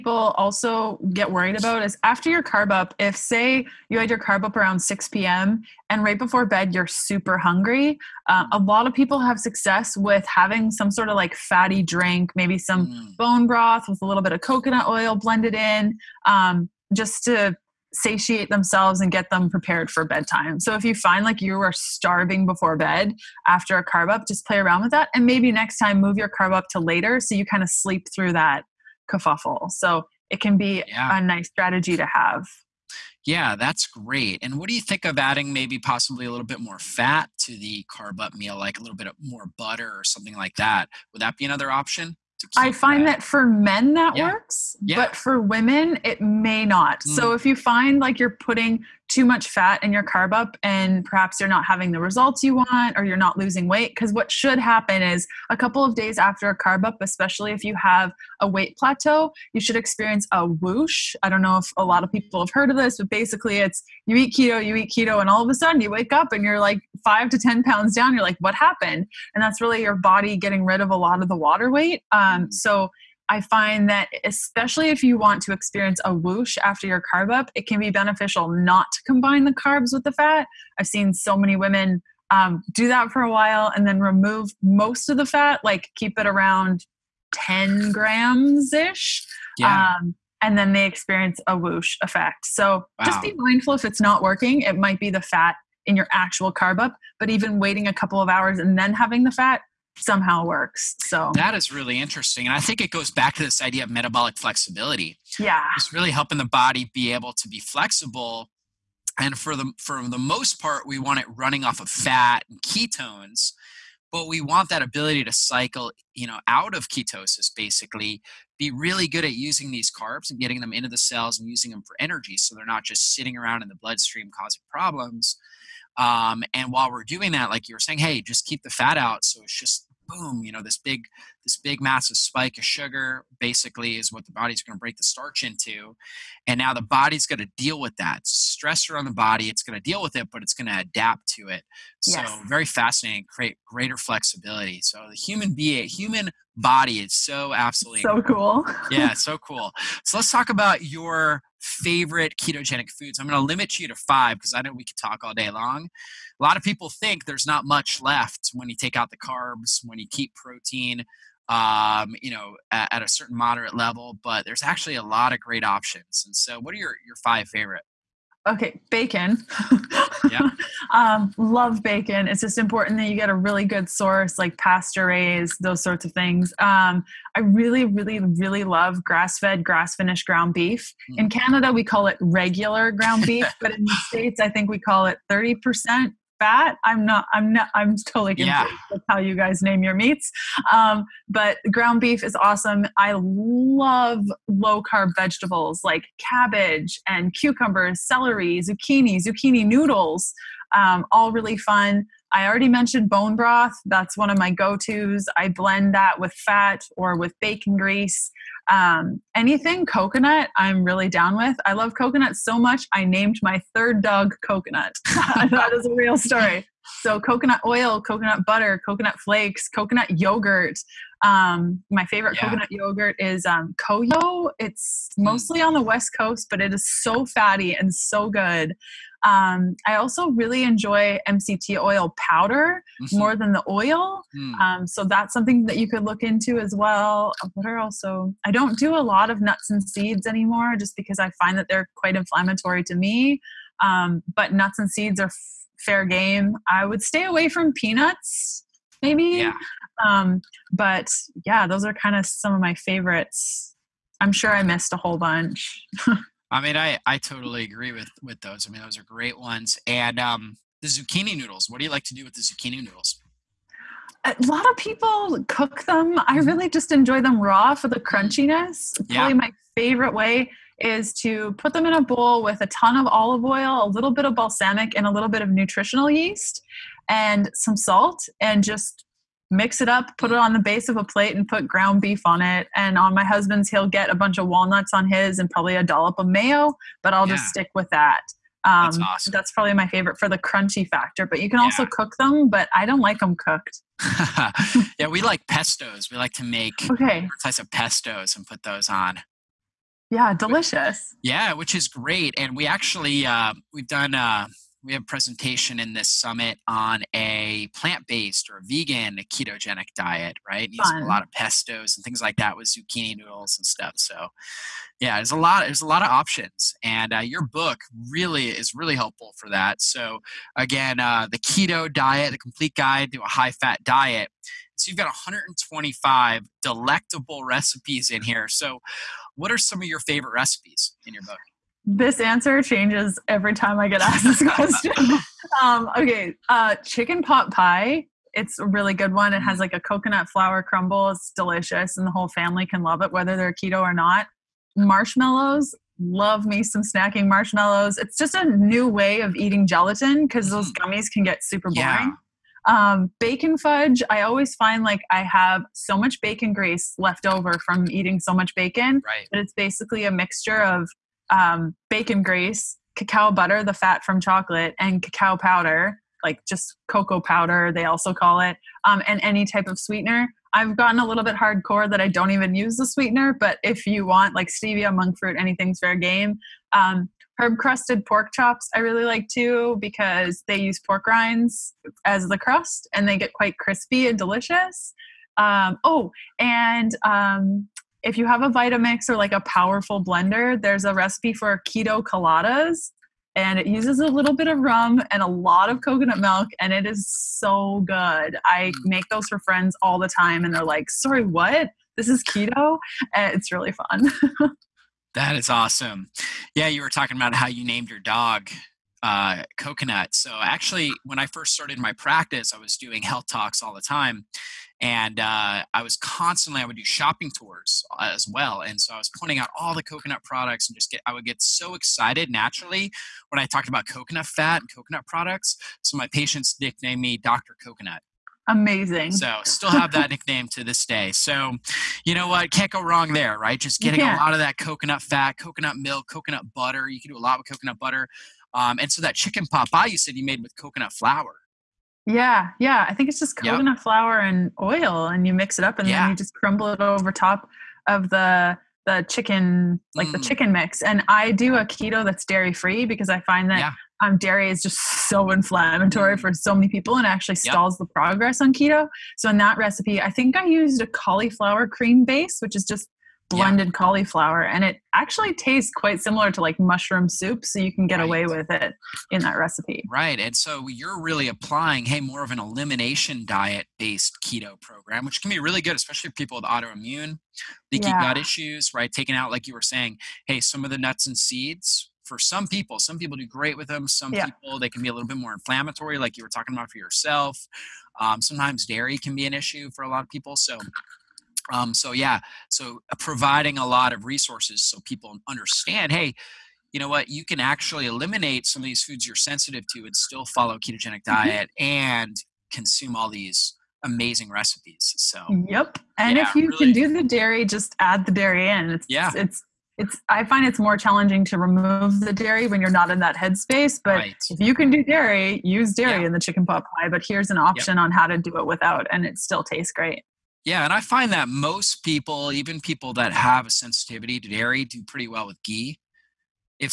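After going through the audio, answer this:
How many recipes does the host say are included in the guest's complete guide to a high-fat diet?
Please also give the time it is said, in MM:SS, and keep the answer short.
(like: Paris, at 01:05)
125, at 05:25.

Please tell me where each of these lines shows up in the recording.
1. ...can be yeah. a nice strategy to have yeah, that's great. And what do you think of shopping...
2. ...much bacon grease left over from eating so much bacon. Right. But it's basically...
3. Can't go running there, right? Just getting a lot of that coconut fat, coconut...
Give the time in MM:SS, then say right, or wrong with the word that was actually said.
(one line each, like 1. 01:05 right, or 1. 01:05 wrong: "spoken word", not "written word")
1. 00:30 wrong: "adding", not "shopping"
2. 05:55 right
3. 07:12 wrong: "wrong", not "running".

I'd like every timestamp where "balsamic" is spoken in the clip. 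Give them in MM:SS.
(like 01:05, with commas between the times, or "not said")
04:34.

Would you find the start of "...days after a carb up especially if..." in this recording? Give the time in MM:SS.
00:55.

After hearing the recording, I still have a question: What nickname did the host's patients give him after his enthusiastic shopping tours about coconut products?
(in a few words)
Doctor Coconut.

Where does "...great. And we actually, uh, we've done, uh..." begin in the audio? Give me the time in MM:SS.
05:01.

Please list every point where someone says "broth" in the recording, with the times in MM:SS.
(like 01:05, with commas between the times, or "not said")
00:13, 03:23.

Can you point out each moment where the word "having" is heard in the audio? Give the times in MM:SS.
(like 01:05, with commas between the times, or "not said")
00:10, 00:51, 01:38.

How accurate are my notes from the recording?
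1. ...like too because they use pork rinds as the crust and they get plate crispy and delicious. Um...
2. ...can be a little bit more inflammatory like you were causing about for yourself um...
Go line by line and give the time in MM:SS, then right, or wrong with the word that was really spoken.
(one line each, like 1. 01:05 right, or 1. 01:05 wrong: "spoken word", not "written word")
1. 06:19 wrong: "quite", not "plate"
2. 08:04 wrong: "talking", not "causing".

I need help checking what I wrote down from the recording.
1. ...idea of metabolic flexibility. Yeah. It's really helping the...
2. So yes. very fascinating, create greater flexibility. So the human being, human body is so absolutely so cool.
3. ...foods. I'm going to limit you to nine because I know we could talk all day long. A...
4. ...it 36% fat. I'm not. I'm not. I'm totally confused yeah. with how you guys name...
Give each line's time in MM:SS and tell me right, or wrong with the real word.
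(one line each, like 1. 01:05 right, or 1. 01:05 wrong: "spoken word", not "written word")
1. 01:43 right
2. 02:21 right
3. 02:32 wrong: "five", not "nine"
4. 03:05 wrong: "30", not "36".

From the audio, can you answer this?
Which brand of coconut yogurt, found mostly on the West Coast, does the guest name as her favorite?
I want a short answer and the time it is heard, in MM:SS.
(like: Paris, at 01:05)
CoYo, at 03:43.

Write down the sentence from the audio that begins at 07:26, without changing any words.
then you just crumble it over top of the the chicken, like mm.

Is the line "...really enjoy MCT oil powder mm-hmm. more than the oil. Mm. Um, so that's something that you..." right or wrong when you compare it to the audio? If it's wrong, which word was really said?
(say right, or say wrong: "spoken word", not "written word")
right.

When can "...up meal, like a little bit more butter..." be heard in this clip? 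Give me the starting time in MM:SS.
00:38.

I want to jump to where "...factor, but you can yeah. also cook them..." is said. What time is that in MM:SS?
04:50.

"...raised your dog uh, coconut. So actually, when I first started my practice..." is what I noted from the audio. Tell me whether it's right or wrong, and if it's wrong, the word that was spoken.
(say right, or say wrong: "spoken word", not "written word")
wrong: "named", not "raised".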